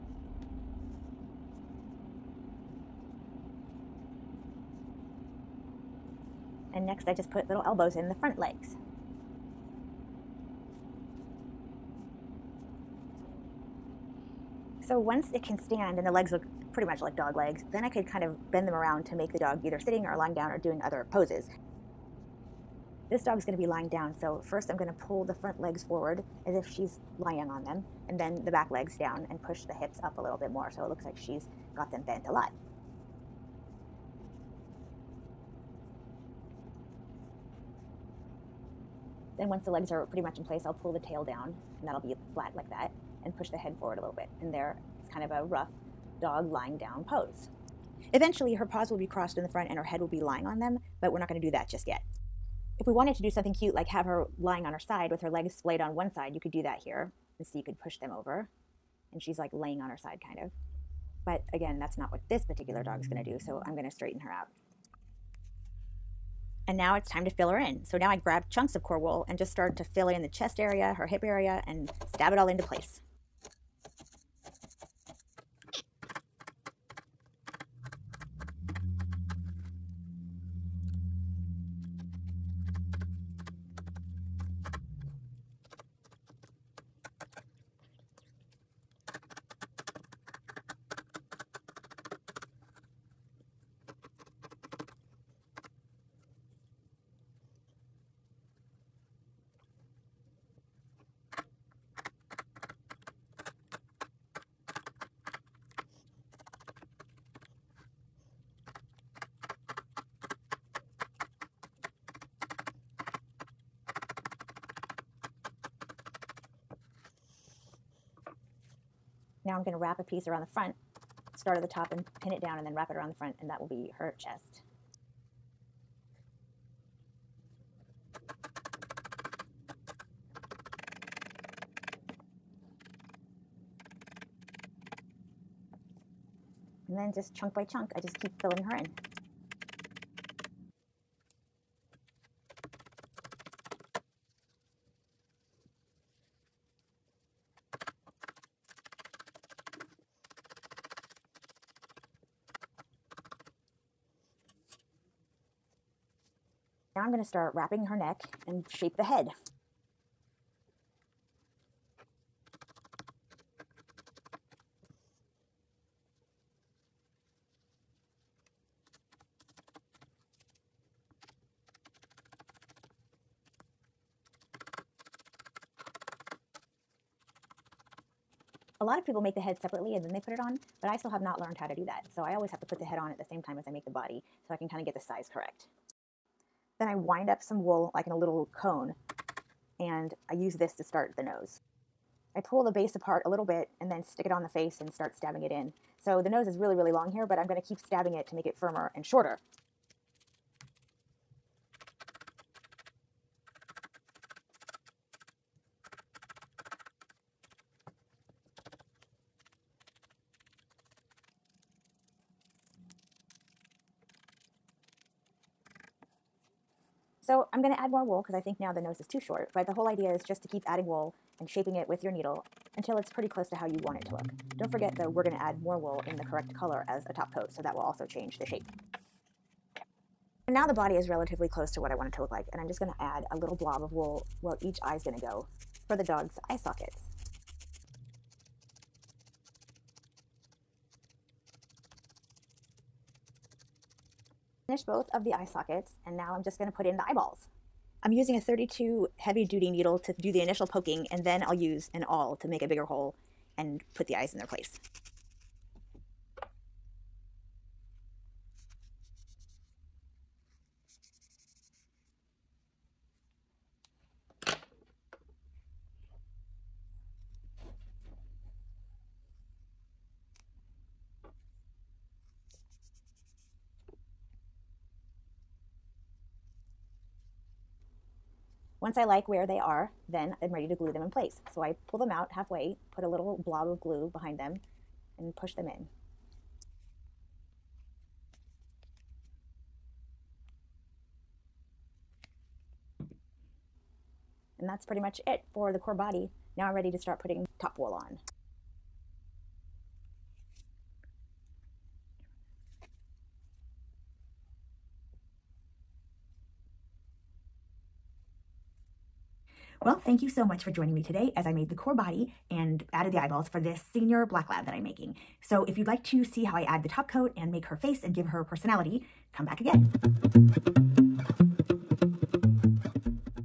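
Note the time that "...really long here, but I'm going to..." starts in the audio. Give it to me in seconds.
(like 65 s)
196 s.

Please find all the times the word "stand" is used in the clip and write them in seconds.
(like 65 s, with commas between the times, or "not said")
15 s.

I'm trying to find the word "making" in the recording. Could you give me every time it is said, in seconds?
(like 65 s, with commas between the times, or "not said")
314 s.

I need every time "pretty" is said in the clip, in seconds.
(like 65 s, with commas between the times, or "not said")
16 s, 40 s, 223 s, 294 s.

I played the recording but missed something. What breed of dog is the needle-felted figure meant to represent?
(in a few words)
Black lab.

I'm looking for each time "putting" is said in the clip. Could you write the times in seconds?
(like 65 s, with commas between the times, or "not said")
297 s.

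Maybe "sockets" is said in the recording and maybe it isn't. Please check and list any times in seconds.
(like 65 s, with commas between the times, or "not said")
236 s, 245 s.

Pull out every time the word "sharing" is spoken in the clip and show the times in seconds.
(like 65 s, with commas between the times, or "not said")
not said.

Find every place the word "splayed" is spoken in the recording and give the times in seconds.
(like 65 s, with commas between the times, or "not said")
55 s.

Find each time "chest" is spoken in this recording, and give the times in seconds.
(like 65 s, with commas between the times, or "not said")
70 s, 124 s.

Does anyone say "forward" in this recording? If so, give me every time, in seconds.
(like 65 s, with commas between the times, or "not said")
25 s, 43 s.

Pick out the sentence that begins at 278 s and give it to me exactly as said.
Once I like where they are, then I'm ready to glue them in place.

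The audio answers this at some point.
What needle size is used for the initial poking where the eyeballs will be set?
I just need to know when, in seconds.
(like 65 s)
248 s.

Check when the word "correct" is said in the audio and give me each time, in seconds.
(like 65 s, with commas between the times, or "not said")
185 s, 226 s.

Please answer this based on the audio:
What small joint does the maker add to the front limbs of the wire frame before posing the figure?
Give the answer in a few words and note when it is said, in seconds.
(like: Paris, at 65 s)
Elbows, at 7 s.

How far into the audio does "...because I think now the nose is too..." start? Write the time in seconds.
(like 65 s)
218 s.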